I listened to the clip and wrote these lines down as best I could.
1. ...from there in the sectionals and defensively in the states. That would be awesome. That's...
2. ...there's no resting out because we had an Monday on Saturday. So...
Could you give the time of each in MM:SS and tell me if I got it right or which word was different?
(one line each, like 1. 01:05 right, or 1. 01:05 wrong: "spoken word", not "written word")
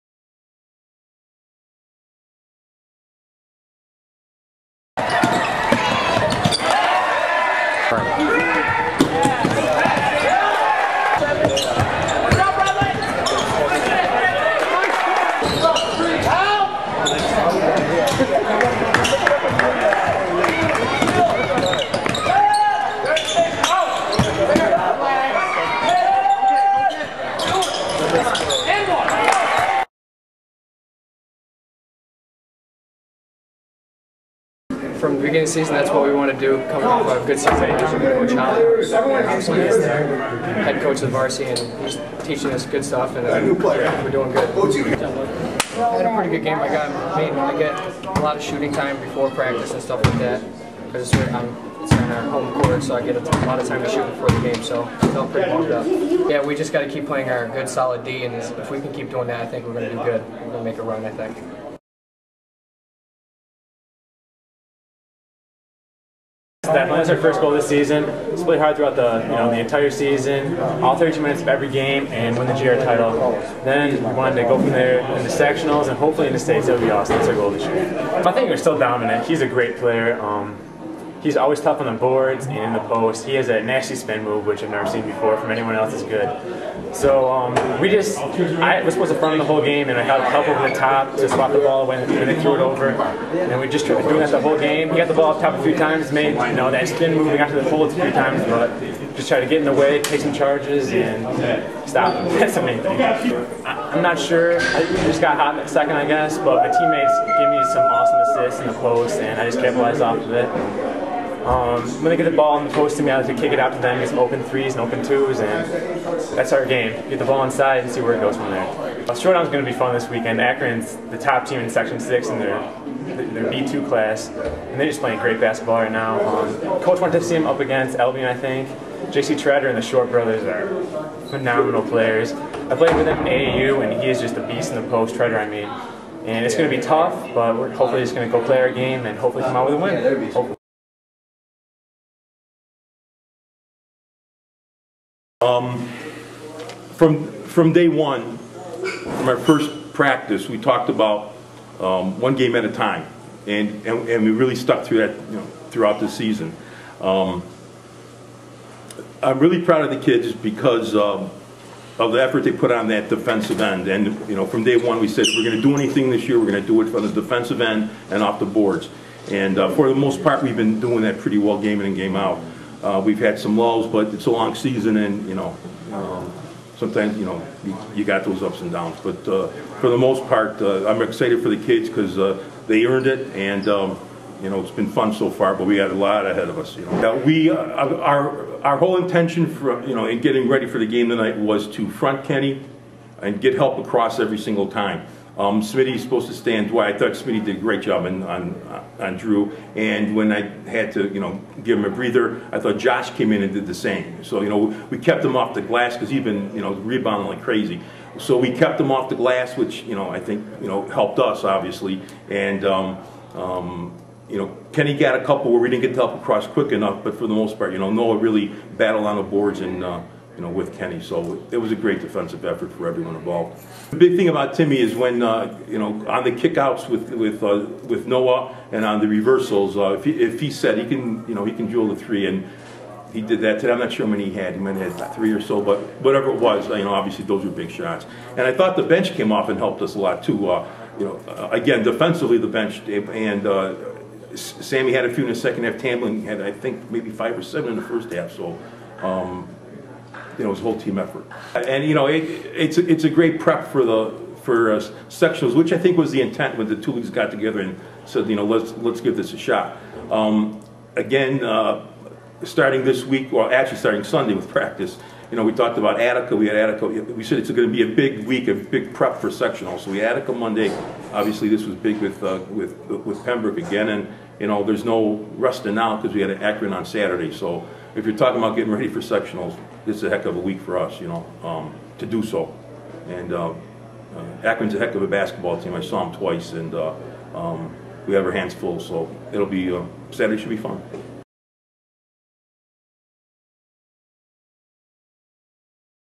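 1. 01:14 wrong: "hopefully", not "defensively"
2. 04:34 wrong: "Akron", not "Monday".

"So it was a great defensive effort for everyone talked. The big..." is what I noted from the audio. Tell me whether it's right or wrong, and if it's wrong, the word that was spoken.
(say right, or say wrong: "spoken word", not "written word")
wrong: "involved", not "talked".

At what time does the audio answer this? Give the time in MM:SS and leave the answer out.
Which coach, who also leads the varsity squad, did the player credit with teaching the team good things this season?
00:37.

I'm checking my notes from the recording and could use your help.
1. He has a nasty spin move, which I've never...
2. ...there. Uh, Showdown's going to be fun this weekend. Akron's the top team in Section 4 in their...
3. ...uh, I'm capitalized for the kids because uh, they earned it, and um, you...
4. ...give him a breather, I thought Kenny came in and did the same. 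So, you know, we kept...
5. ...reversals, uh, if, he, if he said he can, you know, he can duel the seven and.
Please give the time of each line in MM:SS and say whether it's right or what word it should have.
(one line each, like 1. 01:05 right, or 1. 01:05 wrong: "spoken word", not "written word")
1. 01:23 right
2. 01:58 wrong: "6", not "4"
3. 03:00 wrong: "excited", not "capitalized"
4. 03:21 wrong: "Josh", not "Kenny"
5. 03:49 wrong: "three", not "seven".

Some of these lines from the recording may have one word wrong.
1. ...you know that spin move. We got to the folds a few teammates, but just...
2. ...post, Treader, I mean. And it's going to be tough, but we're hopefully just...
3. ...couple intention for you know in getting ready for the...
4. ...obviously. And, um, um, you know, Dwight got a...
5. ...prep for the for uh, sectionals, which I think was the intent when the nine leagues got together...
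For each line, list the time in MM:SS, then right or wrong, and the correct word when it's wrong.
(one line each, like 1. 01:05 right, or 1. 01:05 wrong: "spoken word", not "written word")
1. 01:36 wrong: "times", not "teammates"
2. 02:14 right
3. 03:08 wrong: "whole", not "couple"
4. 03:31 wrong: "Kenny", not "Dwight"
5. 04:13 wrong: "two", not "nine".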